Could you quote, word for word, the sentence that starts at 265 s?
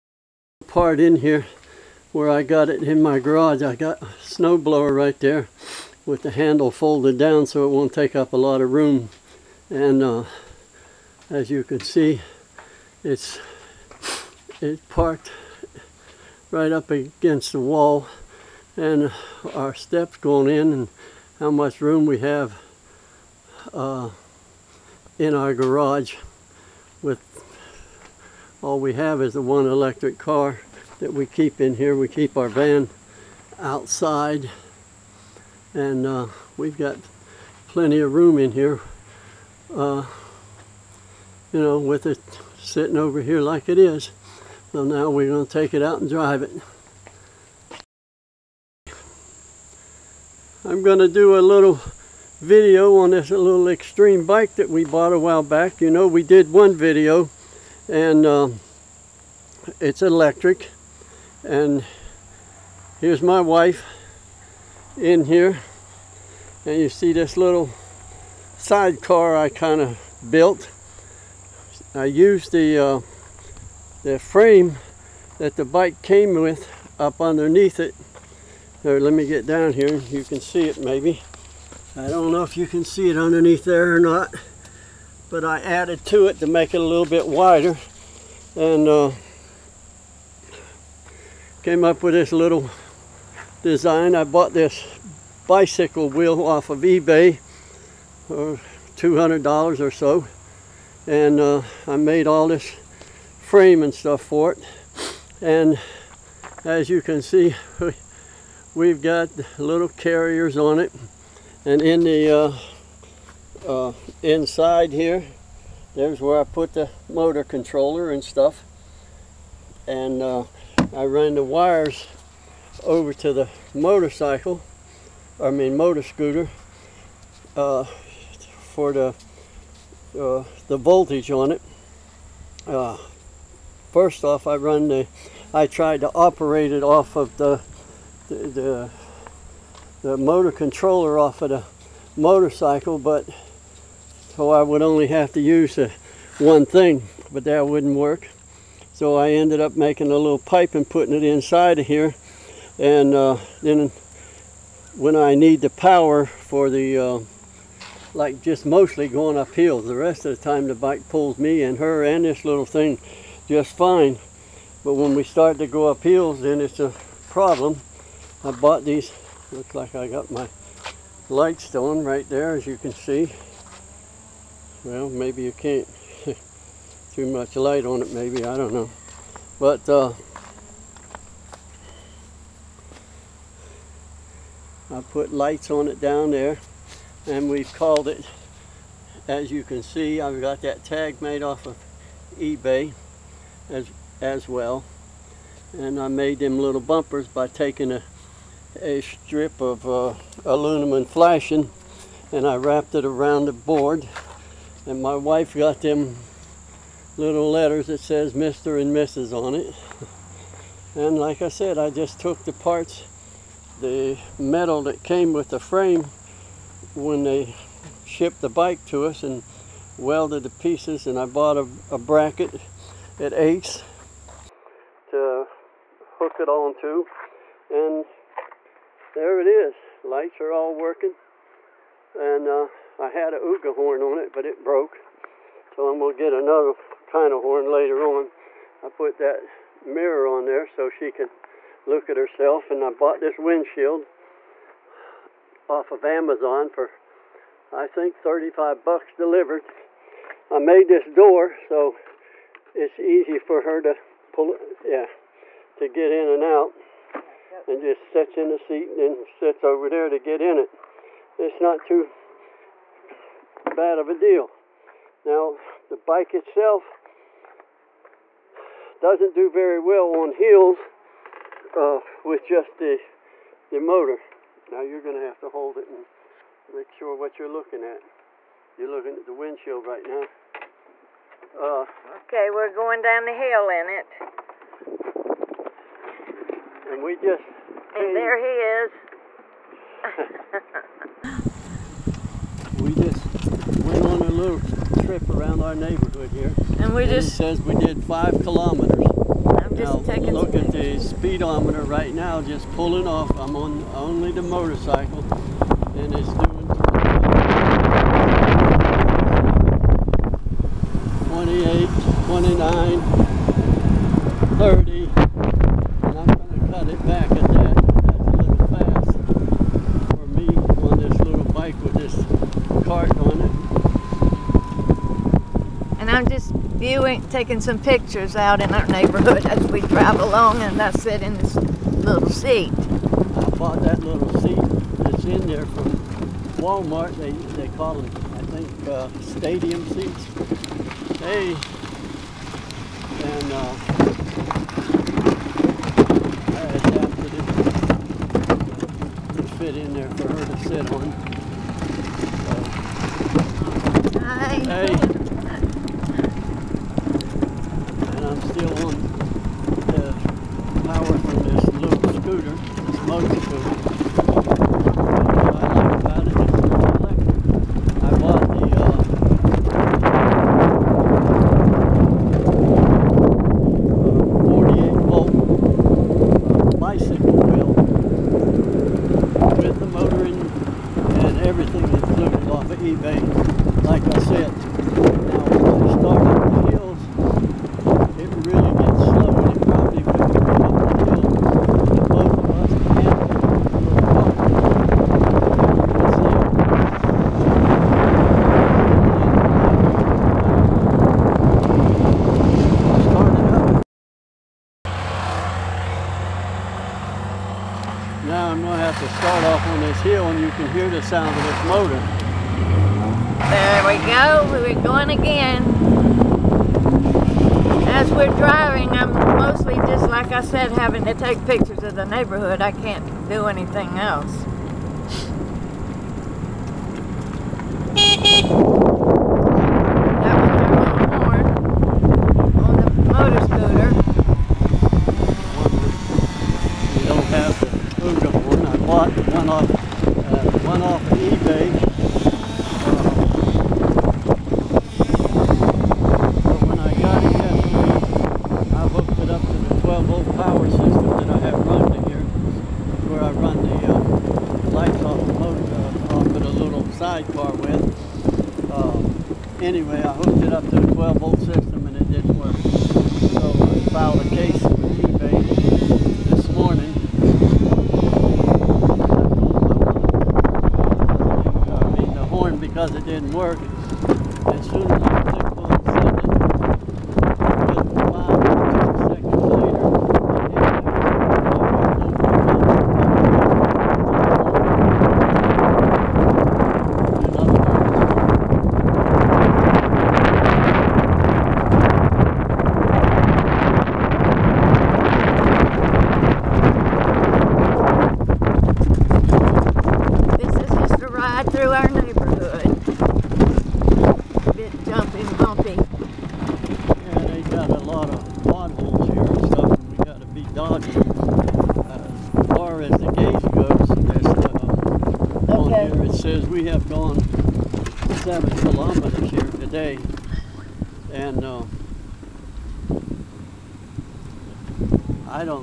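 Now, the bike itself doesn't do very well on hills uh, with just the, the motor.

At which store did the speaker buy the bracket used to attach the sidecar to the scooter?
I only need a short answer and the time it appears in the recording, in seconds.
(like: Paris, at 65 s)
Ace, at 223 s.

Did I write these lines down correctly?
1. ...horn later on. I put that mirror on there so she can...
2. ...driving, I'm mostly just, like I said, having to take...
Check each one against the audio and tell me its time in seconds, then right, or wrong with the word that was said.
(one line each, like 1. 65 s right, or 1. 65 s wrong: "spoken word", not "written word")
1. 237 s right
2. 418 s right.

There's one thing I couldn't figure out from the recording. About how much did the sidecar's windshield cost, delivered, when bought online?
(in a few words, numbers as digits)
$35.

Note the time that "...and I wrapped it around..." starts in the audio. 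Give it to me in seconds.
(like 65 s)
202 s.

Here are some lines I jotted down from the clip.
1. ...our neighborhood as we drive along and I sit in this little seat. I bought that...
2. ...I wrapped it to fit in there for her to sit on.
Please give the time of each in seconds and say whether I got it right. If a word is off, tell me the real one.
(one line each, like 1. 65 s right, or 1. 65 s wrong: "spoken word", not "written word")
1. 328 s right
2. 346 s wrong: "adapted", not "wrapped".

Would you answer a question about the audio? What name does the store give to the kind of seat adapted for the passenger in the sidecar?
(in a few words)
stadium seats.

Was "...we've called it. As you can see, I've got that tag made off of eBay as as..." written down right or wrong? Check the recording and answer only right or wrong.
right.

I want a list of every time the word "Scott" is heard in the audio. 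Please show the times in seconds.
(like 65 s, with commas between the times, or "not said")
not said.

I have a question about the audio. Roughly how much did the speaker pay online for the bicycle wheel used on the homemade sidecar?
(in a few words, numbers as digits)
$200.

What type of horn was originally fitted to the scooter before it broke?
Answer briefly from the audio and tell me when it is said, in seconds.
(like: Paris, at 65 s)
Ooga horn, at 233 s.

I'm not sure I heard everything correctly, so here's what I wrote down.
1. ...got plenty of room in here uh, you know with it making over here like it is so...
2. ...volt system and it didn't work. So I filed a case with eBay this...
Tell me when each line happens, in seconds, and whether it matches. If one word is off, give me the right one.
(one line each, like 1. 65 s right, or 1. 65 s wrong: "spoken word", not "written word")
1. 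36 s wrong: "sitting", not "making"
2. 461 s right.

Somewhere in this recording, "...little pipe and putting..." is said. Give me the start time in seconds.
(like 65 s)
150 s.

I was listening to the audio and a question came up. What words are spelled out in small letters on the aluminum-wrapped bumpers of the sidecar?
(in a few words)
Mr. and Mrs.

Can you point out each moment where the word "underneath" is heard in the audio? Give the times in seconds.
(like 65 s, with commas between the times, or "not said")
77 s, 83 s.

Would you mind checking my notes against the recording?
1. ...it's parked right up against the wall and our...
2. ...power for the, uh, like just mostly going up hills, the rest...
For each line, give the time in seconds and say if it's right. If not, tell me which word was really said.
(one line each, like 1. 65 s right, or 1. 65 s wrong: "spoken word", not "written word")
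1. 14 s right
2. 155 s right.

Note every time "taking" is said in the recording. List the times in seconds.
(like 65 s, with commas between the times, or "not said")
197 s, 300 s, 327 s.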